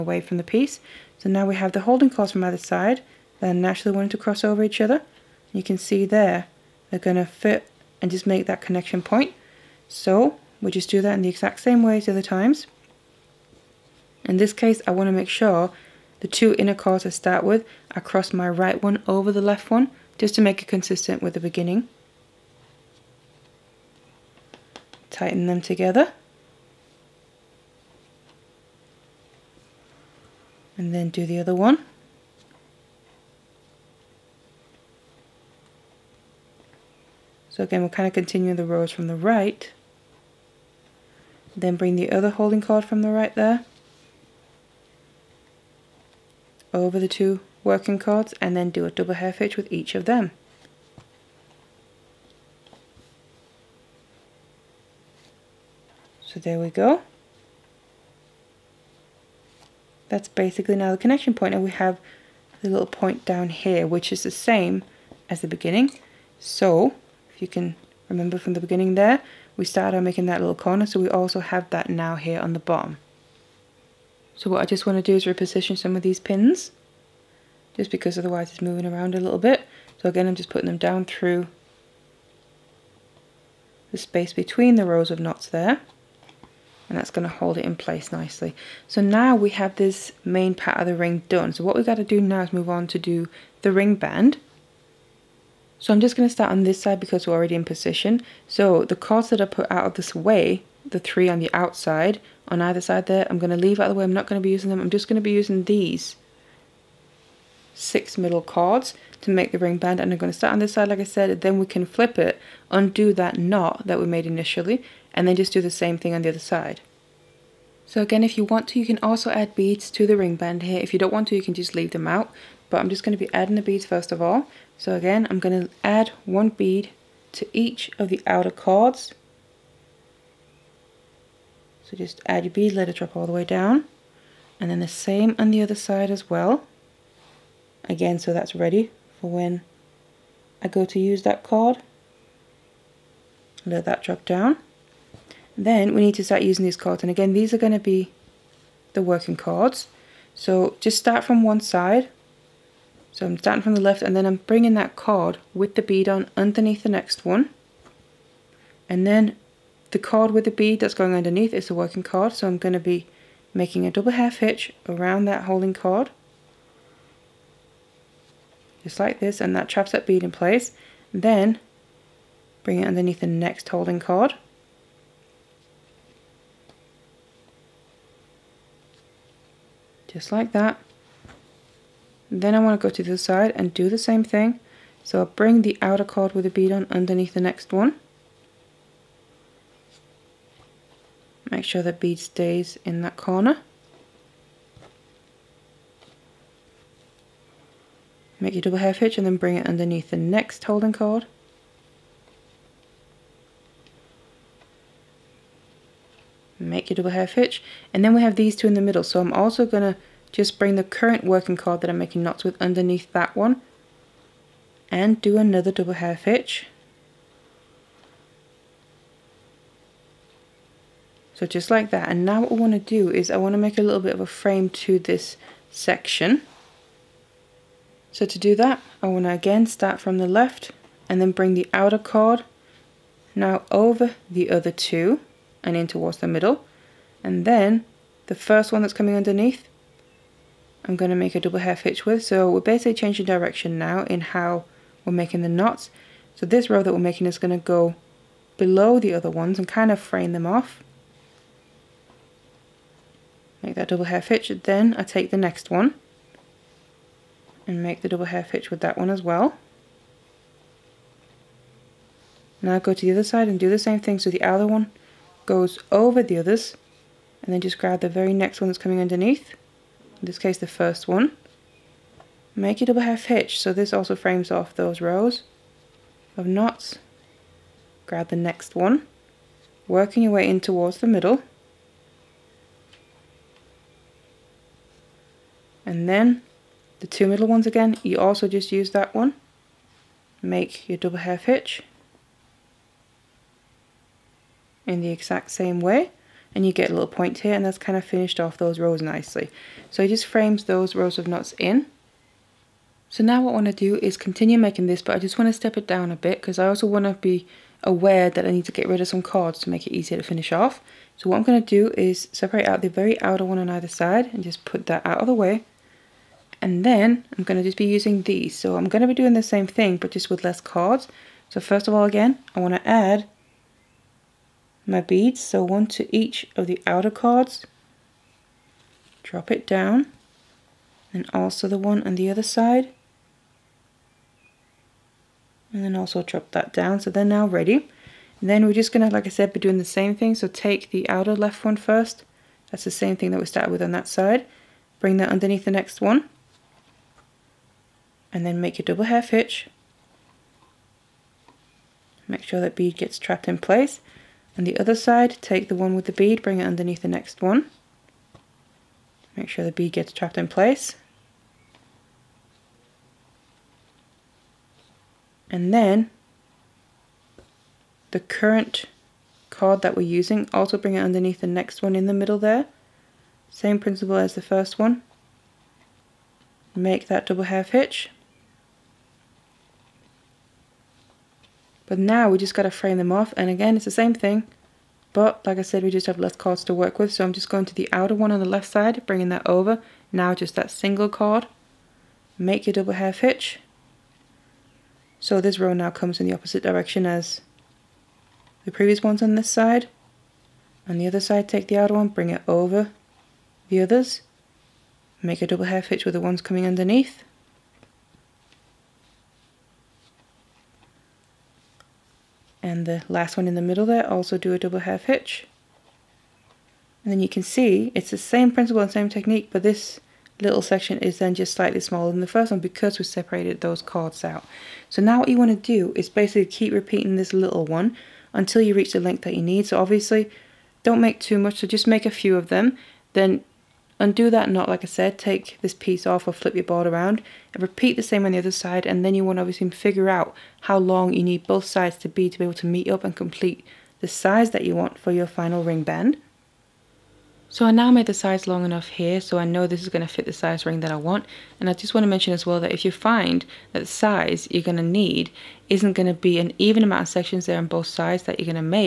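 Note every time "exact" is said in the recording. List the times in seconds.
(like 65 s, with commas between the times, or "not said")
11 s, 295 s.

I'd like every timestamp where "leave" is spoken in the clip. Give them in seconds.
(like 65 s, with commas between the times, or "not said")
103 s, 121 s.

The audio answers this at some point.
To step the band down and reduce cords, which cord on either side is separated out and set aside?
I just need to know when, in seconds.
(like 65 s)
312 s.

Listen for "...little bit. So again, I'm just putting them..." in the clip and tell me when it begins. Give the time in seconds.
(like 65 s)
79 s.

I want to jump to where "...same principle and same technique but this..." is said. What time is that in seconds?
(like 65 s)
418 s.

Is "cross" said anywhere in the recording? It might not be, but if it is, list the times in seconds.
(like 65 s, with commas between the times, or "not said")
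4 s, 17 s.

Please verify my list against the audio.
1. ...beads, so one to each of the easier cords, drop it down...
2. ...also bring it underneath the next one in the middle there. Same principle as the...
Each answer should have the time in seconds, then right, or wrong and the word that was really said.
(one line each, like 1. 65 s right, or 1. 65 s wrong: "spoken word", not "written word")
1. 324 s wrong: "outer", not "easier"
2. 370 s right.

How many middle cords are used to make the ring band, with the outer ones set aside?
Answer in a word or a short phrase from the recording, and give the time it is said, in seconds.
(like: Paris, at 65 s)
6, at 107 s.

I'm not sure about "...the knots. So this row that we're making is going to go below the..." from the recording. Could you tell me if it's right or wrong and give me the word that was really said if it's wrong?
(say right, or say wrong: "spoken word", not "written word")
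right.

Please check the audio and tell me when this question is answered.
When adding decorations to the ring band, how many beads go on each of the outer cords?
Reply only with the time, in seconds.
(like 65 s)
126 s.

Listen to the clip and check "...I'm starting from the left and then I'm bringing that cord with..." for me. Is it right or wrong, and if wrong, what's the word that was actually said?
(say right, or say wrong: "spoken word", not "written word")
right.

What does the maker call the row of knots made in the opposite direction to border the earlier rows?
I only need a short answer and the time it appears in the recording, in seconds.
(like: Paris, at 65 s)
a frame, at 223 s.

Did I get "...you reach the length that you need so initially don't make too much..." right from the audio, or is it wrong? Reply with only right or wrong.
wrong.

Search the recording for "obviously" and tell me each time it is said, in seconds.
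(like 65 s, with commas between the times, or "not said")
429 s, 439 s.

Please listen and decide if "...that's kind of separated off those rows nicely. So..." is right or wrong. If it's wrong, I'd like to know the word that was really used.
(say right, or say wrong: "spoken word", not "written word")
wrong: "finished", not "separated".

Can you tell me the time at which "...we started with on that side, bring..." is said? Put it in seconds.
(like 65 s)
343 s.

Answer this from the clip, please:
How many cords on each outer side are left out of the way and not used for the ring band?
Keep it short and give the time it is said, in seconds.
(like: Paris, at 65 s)
3, at 100 s.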